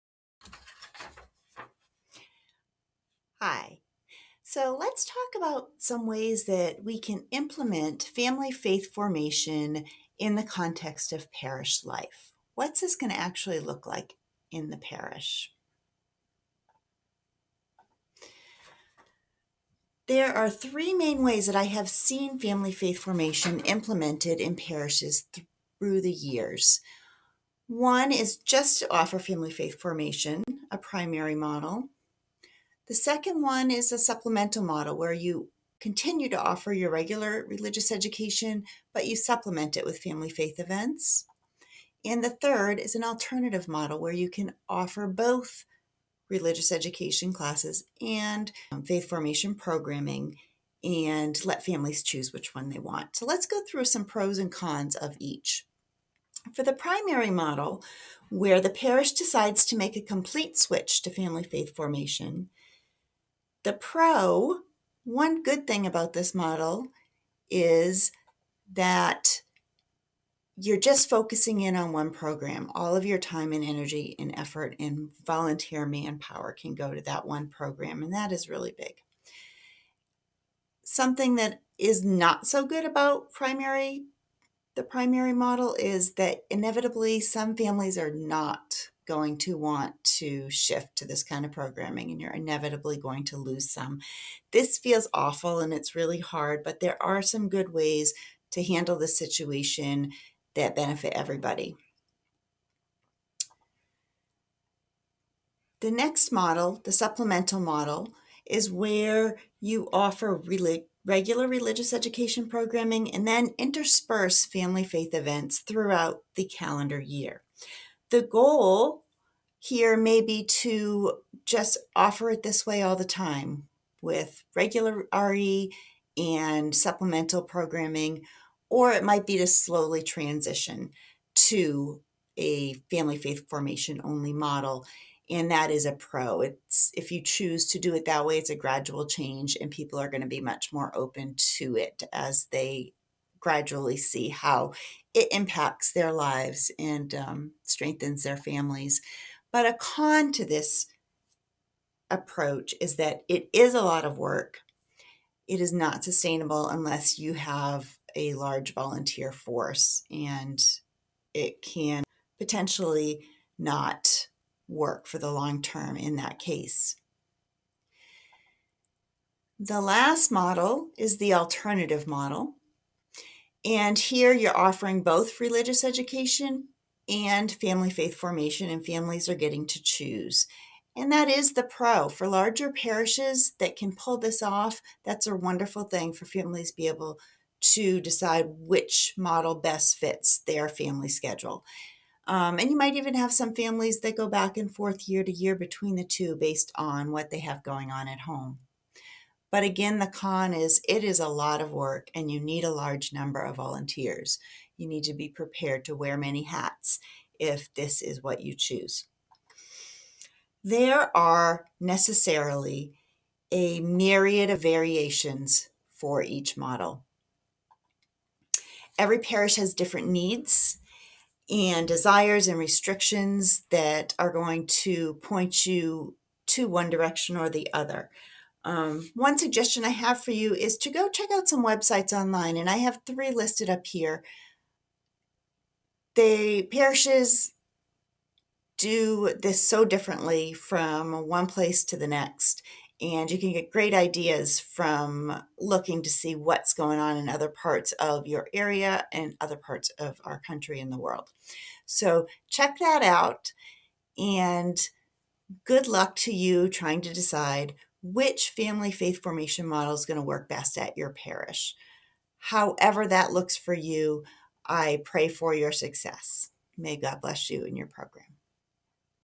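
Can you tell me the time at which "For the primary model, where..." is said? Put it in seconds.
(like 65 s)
56 s.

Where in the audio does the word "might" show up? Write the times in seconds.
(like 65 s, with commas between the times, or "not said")
129 s, 192 s.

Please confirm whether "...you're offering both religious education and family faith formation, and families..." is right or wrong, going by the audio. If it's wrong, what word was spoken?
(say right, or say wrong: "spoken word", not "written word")
right.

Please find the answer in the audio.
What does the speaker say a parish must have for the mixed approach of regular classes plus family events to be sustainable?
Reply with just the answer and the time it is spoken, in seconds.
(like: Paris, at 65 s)
A large volunteer force, at 158 s.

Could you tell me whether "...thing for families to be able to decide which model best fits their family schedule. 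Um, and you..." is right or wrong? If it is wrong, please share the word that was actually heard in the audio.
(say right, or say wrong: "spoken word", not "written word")
right.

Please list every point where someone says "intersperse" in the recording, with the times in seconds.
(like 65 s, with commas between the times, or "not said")
113 s.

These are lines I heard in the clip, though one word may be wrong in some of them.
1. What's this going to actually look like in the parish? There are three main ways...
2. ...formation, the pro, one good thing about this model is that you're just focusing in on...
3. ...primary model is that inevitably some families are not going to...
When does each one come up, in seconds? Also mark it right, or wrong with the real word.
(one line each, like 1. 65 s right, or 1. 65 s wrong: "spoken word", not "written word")
1. 12 s right
2. 61 s right
3. 84 s right.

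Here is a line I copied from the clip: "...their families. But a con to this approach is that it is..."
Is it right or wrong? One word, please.
right.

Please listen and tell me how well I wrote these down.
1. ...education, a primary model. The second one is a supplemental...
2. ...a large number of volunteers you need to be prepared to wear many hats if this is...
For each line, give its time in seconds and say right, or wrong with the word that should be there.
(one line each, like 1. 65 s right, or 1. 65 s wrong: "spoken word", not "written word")
1. 29 s wrong: "formation", not "education"
2. 202 s right.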